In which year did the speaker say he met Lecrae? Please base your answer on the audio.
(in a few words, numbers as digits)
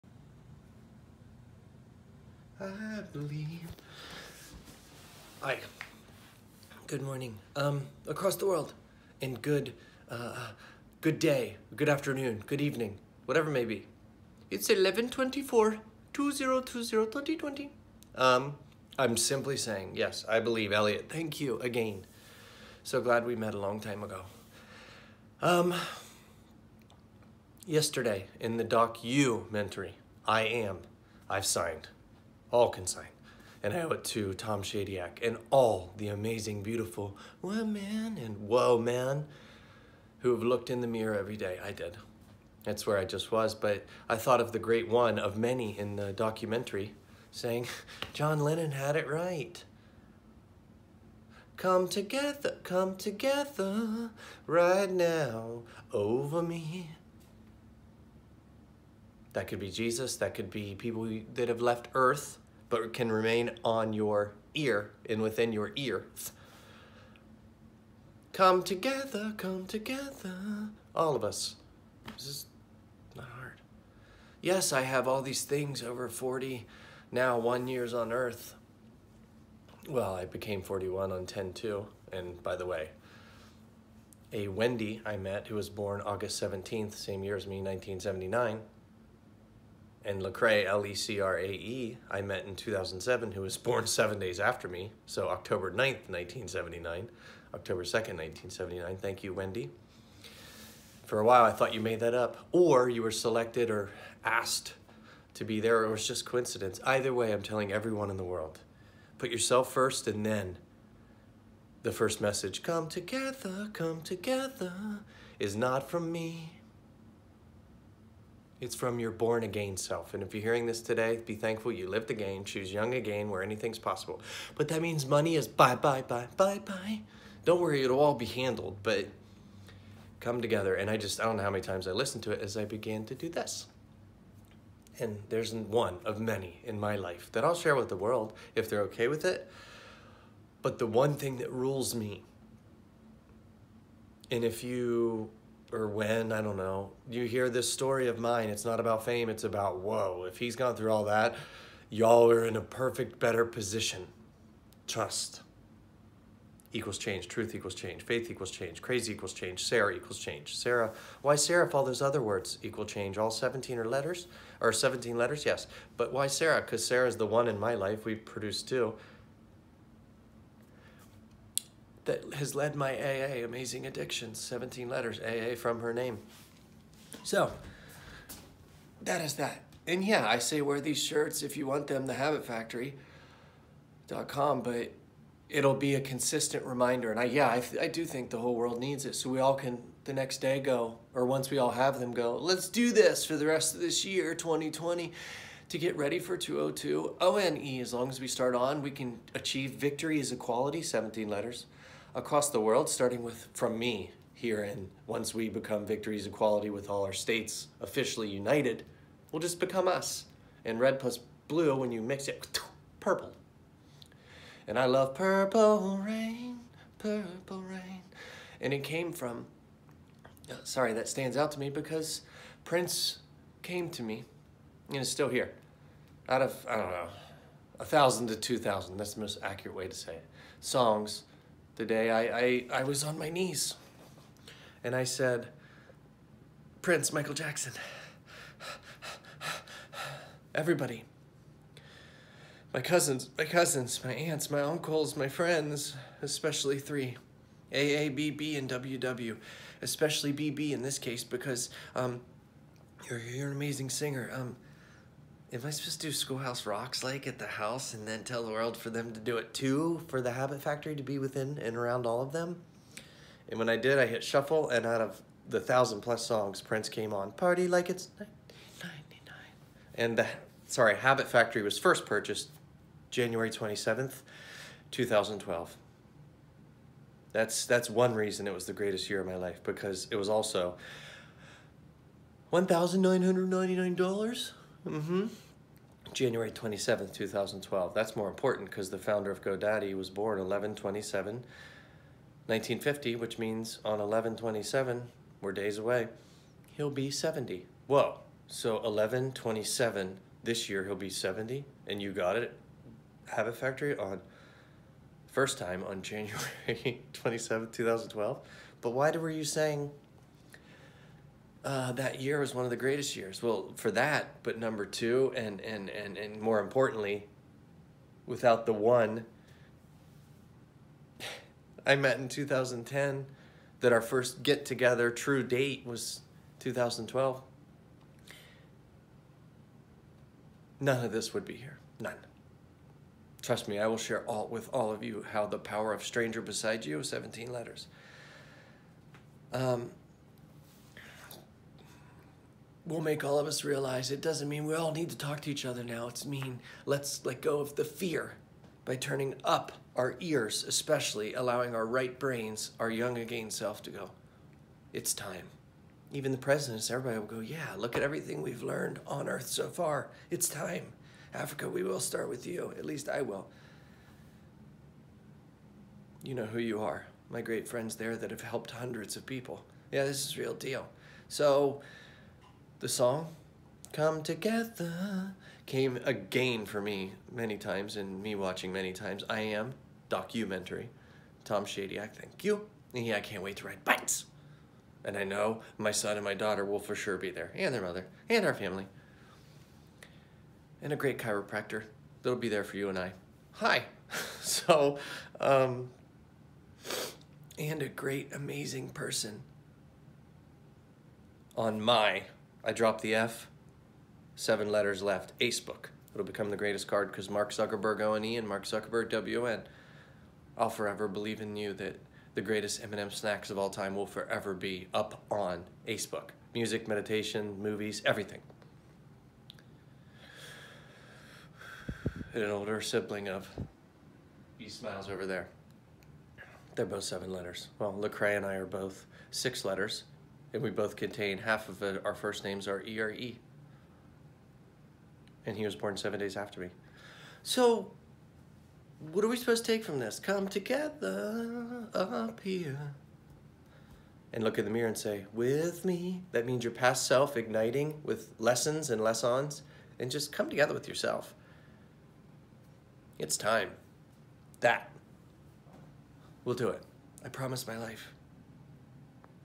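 2007.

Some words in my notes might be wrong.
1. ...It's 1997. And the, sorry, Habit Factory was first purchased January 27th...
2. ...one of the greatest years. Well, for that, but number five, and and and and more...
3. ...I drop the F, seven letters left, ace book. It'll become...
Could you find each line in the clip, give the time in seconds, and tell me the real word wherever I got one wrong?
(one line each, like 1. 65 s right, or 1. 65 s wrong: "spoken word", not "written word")
1. 267 s wrong: "1999", not "1997"
2. 312 s wrong: "two", not "five"
3. 402 s right.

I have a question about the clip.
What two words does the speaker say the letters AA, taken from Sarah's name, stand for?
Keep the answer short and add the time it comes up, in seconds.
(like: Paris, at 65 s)
Amazing Addictions, at 173 s.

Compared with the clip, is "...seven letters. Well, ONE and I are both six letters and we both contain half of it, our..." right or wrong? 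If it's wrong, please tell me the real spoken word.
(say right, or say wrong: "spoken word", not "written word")
wrong: "Lecrae", not "ONE".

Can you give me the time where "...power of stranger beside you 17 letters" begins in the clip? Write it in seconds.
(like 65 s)
335 s.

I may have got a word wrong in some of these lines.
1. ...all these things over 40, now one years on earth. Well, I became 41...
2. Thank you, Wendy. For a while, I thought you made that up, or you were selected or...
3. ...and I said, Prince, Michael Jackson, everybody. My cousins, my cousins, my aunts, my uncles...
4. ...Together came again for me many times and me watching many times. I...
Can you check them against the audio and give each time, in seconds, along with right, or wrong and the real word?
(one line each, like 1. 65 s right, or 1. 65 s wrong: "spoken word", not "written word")
1. 75 s right
2. 98 s right
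3. 234 s right
4. 374 s right.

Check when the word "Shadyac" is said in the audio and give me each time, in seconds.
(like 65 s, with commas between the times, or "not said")
34 s, 381 s.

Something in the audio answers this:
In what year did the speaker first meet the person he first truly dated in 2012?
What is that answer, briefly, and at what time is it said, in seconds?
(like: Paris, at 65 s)
2010, at 322 s.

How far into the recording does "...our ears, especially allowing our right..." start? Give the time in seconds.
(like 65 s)
349 s.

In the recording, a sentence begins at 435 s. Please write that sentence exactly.
And he was born seven days after me.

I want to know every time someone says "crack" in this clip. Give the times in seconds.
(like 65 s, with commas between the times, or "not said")
not said.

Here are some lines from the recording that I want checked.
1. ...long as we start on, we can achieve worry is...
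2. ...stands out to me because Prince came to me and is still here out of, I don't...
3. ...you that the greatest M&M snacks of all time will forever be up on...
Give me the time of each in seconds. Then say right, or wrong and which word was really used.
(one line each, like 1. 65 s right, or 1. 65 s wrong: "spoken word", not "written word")
1. 197 s wrong: "victory", not "worry"
2. 221 s right
3. 411 s right.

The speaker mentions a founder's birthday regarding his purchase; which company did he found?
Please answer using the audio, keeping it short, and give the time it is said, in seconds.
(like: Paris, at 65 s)
GoDaddy, at 289 s.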